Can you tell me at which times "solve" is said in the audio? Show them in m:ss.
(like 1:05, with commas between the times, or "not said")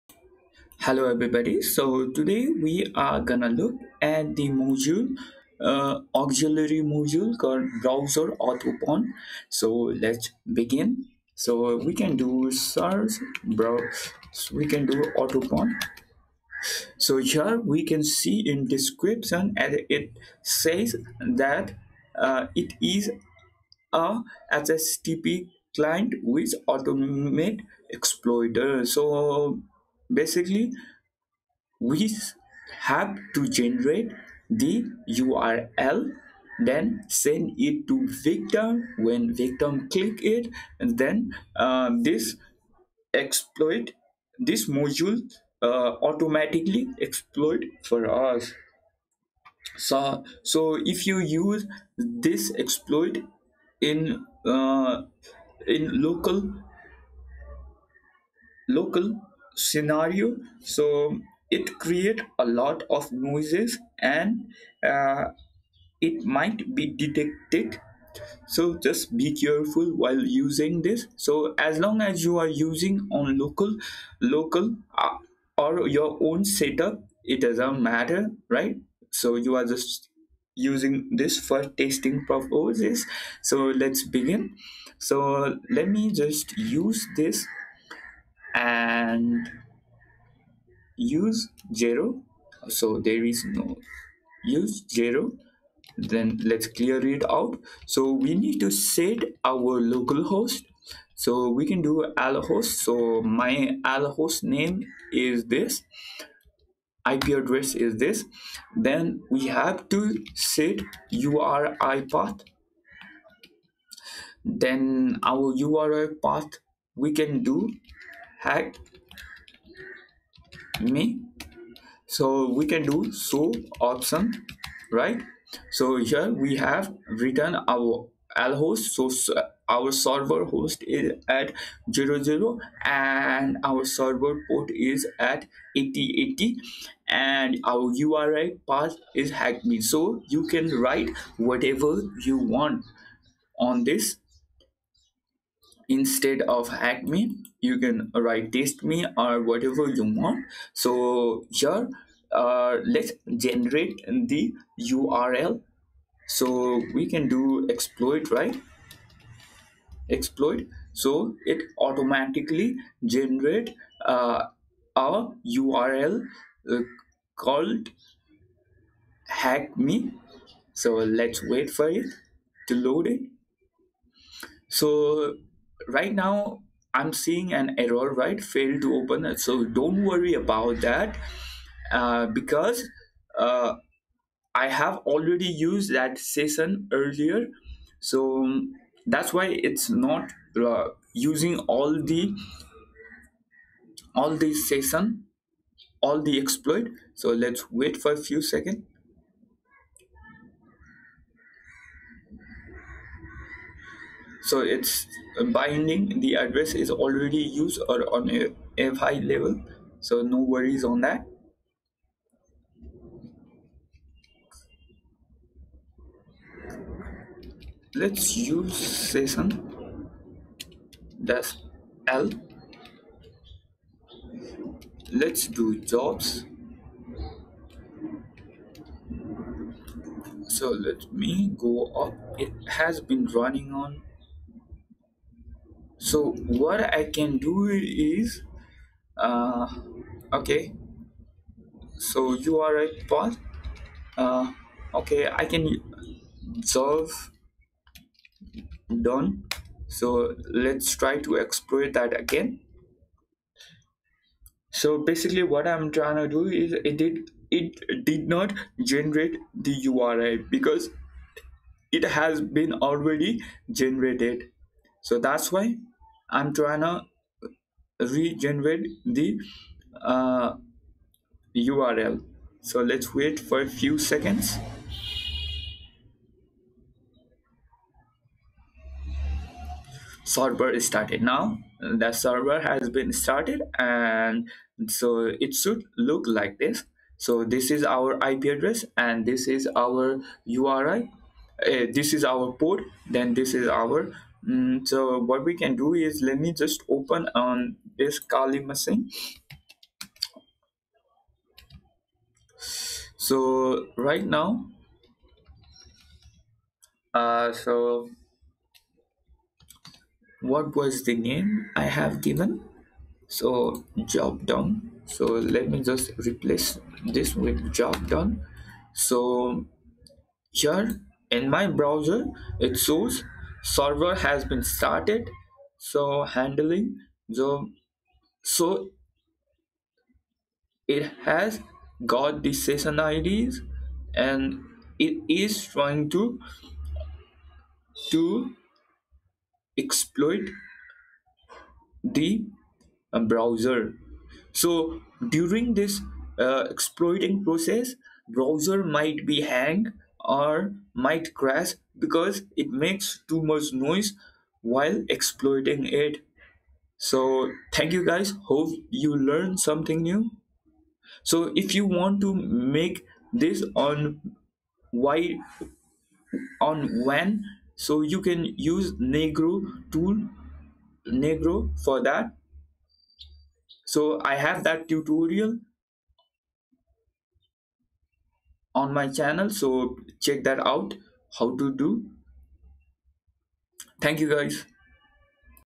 4:06.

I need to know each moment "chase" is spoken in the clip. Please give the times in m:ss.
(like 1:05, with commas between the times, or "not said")
not said.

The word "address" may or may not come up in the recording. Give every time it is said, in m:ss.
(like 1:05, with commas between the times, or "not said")
1:47, 3:26, 4:48.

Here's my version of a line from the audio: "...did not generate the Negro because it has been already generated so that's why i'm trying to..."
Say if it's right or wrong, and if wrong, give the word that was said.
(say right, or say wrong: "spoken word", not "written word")
wrong: "URI", not "Negro".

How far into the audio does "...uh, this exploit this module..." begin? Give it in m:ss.
0:41.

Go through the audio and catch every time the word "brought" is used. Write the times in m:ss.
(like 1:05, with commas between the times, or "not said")
not said.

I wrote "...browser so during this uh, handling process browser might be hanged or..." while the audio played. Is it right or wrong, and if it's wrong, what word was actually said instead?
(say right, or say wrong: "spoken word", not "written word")
wrong: "exploiting", not "handling".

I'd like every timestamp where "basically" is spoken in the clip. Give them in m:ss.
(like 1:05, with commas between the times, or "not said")
0:30, 4:15.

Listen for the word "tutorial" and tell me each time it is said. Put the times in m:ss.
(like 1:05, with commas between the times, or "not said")
6:14.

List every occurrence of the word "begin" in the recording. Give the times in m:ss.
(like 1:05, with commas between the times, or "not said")
0:10, 1:24.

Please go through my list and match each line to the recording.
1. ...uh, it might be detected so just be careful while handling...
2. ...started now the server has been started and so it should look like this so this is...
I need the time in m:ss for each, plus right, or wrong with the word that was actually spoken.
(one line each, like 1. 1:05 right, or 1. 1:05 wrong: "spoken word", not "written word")
1. 1:04 wrong: "using", not "handling"
2. 4:40 right.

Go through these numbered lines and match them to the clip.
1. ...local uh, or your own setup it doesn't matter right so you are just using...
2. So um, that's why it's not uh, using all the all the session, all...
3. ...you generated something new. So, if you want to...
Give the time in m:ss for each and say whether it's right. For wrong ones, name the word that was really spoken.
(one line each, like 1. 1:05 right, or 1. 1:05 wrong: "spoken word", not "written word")
1. 1:14 right
2. 3:08 right
3. 5:58 wrong: "learned", not "generated".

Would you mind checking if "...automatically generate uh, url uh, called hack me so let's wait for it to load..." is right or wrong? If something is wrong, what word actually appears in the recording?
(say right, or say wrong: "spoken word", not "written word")
right.